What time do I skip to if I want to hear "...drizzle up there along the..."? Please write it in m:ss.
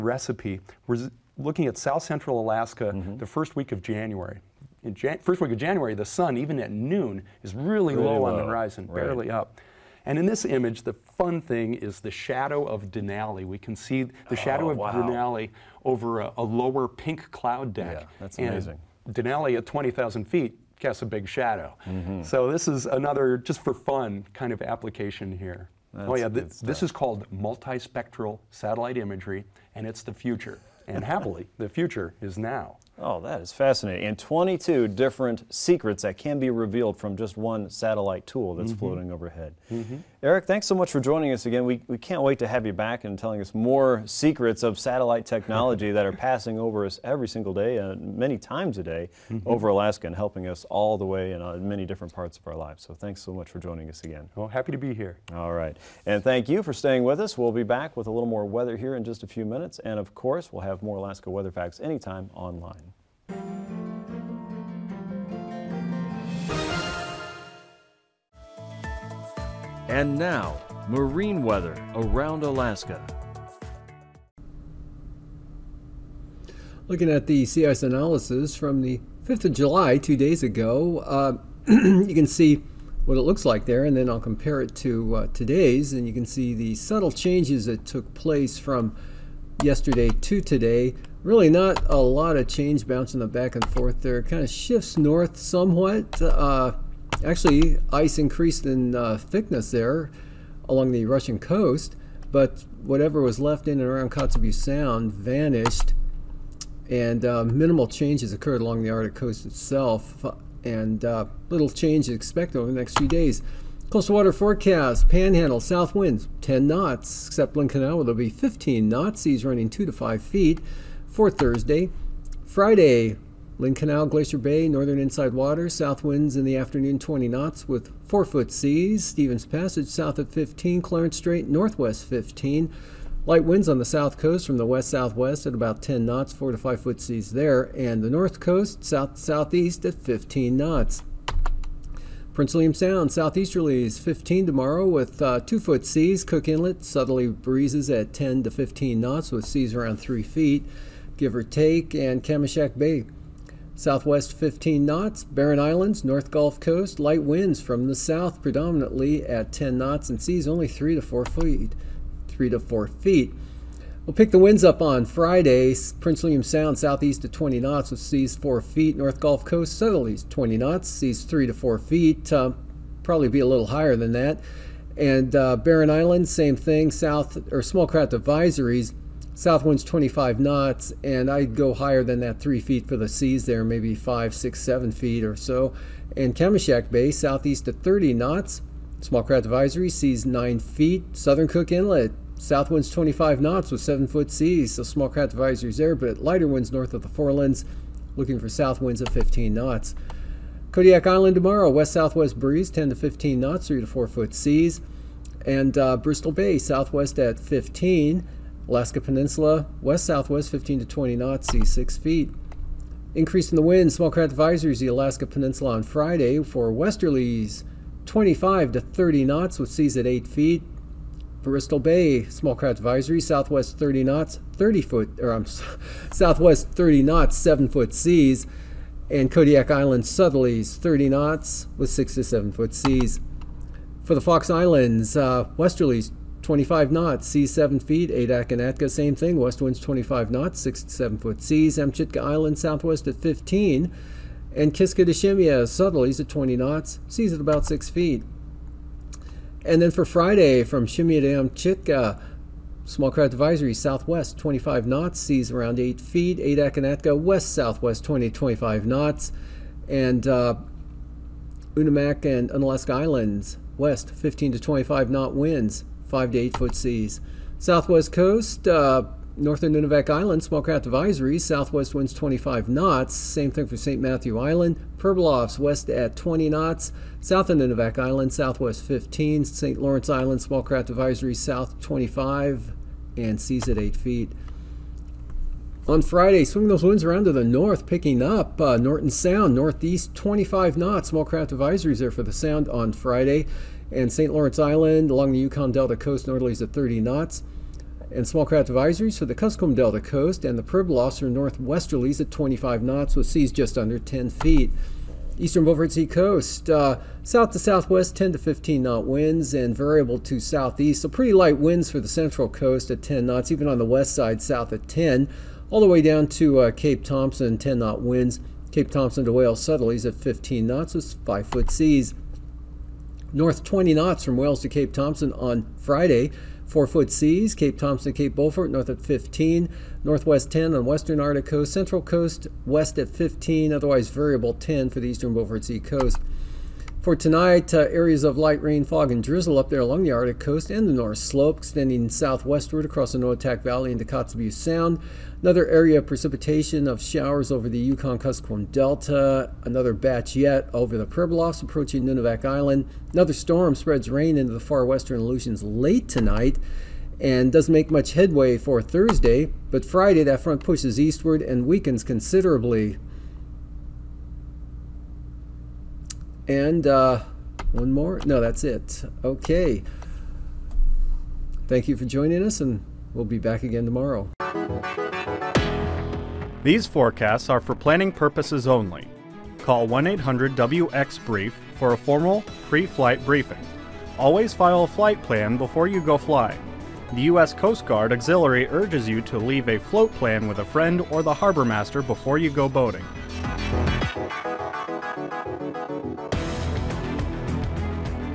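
5:39.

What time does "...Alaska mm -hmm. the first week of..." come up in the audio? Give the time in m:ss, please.
0:02.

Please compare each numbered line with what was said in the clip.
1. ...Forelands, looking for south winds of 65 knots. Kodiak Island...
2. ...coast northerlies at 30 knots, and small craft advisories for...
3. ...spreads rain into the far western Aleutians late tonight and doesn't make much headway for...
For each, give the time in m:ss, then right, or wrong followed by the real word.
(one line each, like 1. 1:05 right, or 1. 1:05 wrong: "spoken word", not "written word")
1. 3:17 wrong: "15", not "65"
2. 4:55 right
3. 5:53 right.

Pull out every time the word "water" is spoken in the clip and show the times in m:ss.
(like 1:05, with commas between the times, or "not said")
1:54, 2:05.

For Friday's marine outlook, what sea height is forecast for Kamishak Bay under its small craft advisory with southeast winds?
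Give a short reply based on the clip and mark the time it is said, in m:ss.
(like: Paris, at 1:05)
9 feet, at 3:09.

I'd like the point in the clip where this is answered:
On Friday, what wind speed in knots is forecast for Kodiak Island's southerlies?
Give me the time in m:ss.
3:49.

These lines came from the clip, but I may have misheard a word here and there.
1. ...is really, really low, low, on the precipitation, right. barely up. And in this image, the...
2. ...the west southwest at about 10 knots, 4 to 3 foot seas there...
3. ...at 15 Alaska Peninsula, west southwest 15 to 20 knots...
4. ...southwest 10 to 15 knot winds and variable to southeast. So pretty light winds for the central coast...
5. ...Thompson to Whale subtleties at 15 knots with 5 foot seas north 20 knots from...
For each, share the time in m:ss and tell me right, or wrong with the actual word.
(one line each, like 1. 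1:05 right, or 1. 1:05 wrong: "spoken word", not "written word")
1. 0:07 wrong: "horizon", not "precipitation"
2. 2:14 wrong: "5", not "3"
3. 3:27 right
4. 5:07 right
5. 5:18 right.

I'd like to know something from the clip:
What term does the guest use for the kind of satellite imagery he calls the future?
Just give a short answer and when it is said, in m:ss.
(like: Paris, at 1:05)
multispectral satellite imagery, at 0:27.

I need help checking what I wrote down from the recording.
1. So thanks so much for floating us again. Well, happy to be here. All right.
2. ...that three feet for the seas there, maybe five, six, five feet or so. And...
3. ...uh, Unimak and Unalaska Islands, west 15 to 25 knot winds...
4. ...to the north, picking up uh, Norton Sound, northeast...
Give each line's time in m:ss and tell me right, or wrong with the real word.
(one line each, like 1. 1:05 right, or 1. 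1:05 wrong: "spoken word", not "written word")
1. 0:52 wrong: "joining", not "floating"
2. 3:02 wrong: "seven", not "five"
3. 4:20 right
4. 4:47 right.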